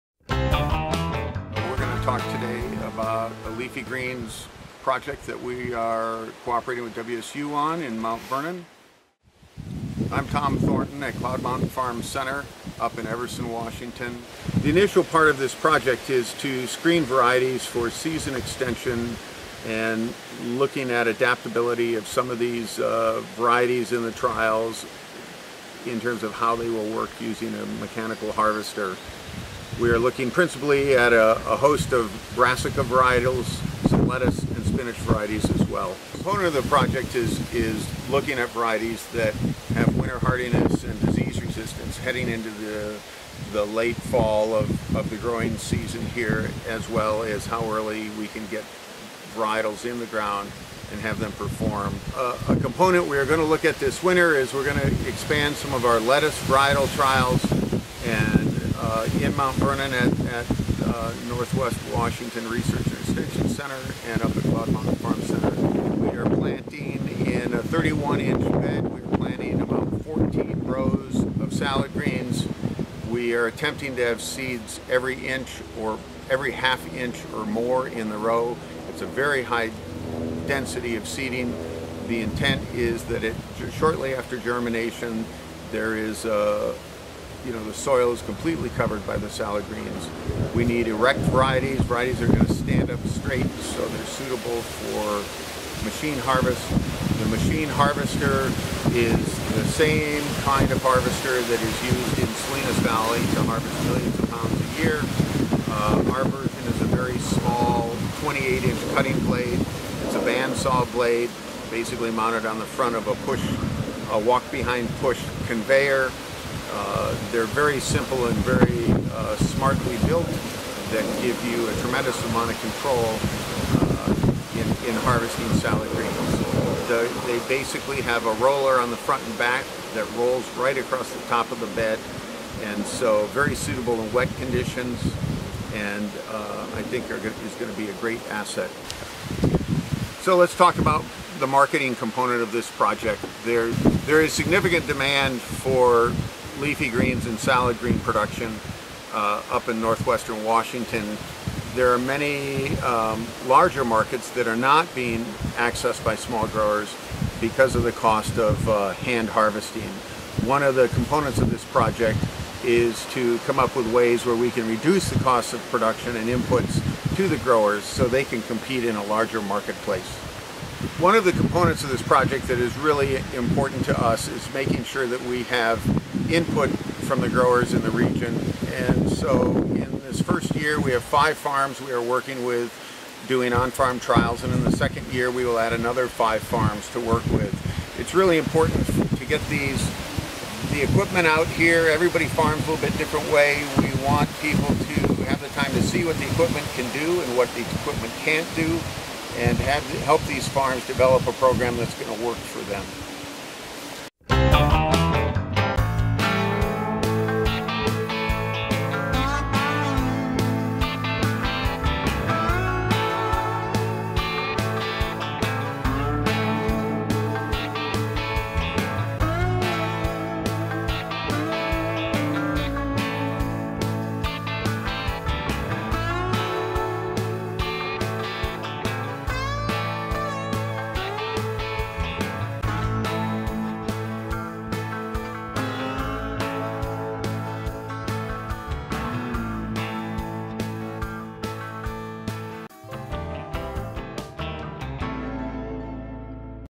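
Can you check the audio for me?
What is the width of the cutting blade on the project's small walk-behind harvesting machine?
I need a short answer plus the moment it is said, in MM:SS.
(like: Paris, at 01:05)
28 inches, at 01:48.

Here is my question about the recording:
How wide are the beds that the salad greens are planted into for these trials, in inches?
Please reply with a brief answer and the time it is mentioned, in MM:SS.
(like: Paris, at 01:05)
31 inches, at 01:07.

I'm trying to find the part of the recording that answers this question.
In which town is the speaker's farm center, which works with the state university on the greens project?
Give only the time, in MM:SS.
00:13.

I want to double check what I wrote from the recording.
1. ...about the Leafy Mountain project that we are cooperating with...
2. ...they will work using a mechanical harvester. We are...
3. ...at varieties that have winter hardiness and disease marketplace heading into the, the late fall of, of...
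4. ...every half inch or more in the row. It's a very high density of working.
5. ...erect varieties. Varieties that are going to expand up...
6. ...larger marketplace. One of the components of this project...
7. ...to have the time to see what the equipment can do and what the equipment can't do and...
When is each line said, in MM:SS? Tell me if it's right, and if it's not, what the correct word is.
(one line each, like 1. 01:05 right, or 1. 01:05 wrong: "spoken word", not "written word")
1. 00:02 wrong: "Greens", not "Mountain"
2. 00:26 right
3. 00:38 wrong: "resistance", not "marketplace"
4. 01:16 wrong: "seeding", not "working"
5. 01:30 wrong: "stand", not "expand"
6. 02:49 right
7. 03:14 right.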